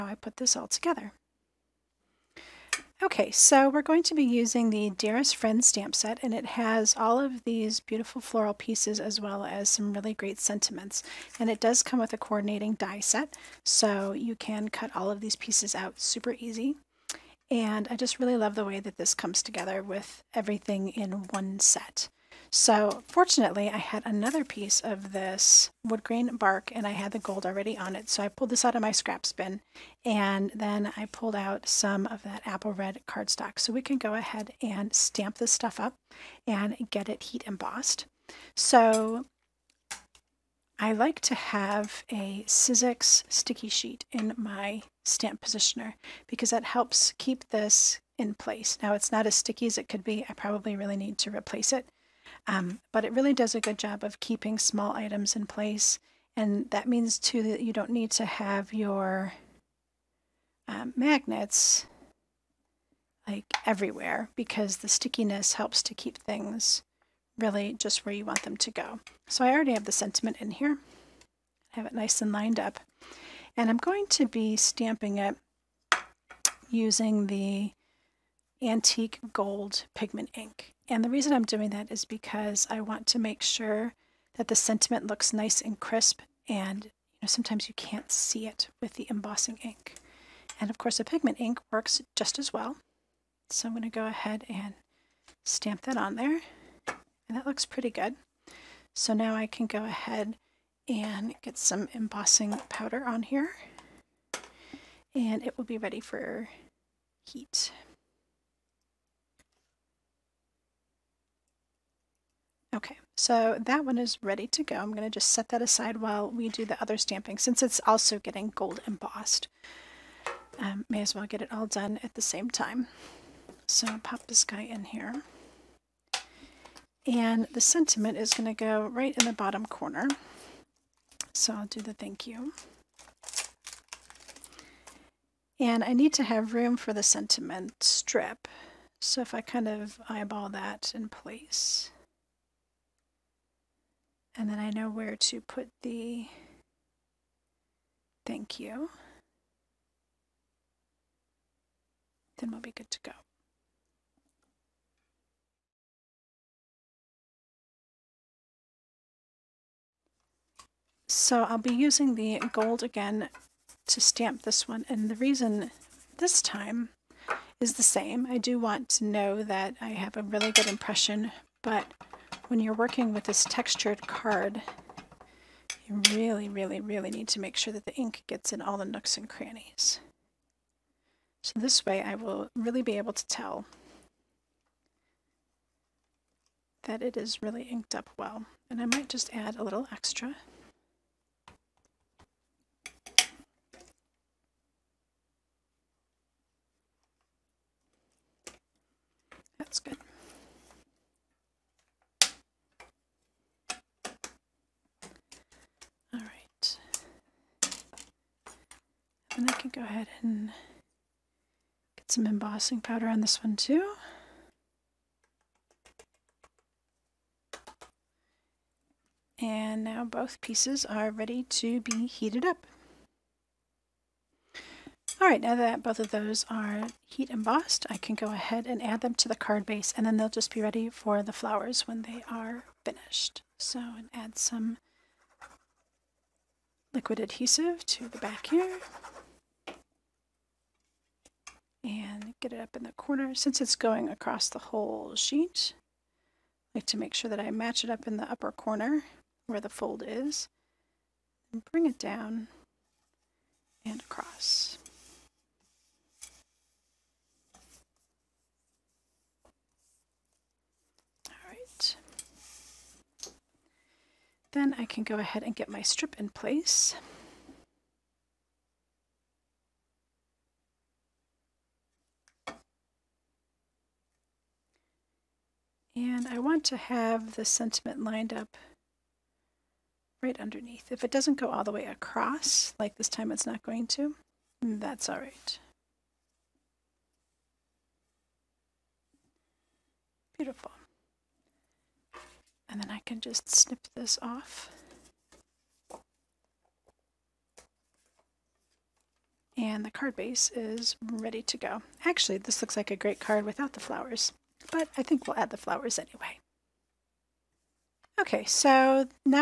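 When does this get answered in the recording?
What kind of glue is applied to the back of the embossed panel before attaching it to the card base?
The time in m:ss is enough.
3:56.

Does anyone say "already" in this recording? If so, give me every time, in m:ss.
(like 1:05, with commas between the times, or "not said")
0:27, 1:09.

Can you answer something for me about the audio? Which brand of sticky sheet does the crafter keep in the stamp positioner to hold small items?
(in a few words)
Sizzix.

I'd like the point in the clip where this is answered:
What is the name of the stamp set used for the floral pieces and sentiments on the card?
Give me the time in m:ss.
0:04.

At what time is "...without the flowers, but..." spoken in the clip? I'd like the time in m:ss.
5:03.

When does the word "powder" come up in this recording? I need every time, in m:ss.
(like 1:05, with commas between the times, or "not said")
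1:42, 3:32.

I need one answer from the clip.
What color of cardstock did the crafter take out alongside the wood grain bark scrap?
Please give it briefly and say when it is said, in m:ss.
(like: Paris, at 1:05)
apple red, at 0:32.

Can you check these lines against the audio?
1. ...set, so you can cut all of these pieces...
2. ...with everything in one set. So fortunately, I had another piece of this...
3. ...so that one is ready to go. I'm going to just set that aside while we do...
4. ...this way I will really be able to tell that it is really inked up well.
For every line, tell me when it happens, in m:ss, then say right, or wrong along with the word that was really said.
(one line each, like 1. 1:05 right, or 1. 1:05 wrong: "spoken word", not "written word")
1. 0:12 right
2. 0:19 right
3. 1:53 right
4. 3:01 right.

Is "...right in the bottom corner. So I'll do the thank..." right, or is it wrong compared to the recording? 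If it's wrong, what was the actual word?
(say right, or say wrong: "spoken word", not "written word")
right.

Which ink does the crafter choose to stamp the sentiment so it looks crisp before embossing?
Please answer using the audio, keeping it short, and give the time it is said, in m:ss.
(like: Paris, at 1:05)
antique gold pigment ink, at 1:18.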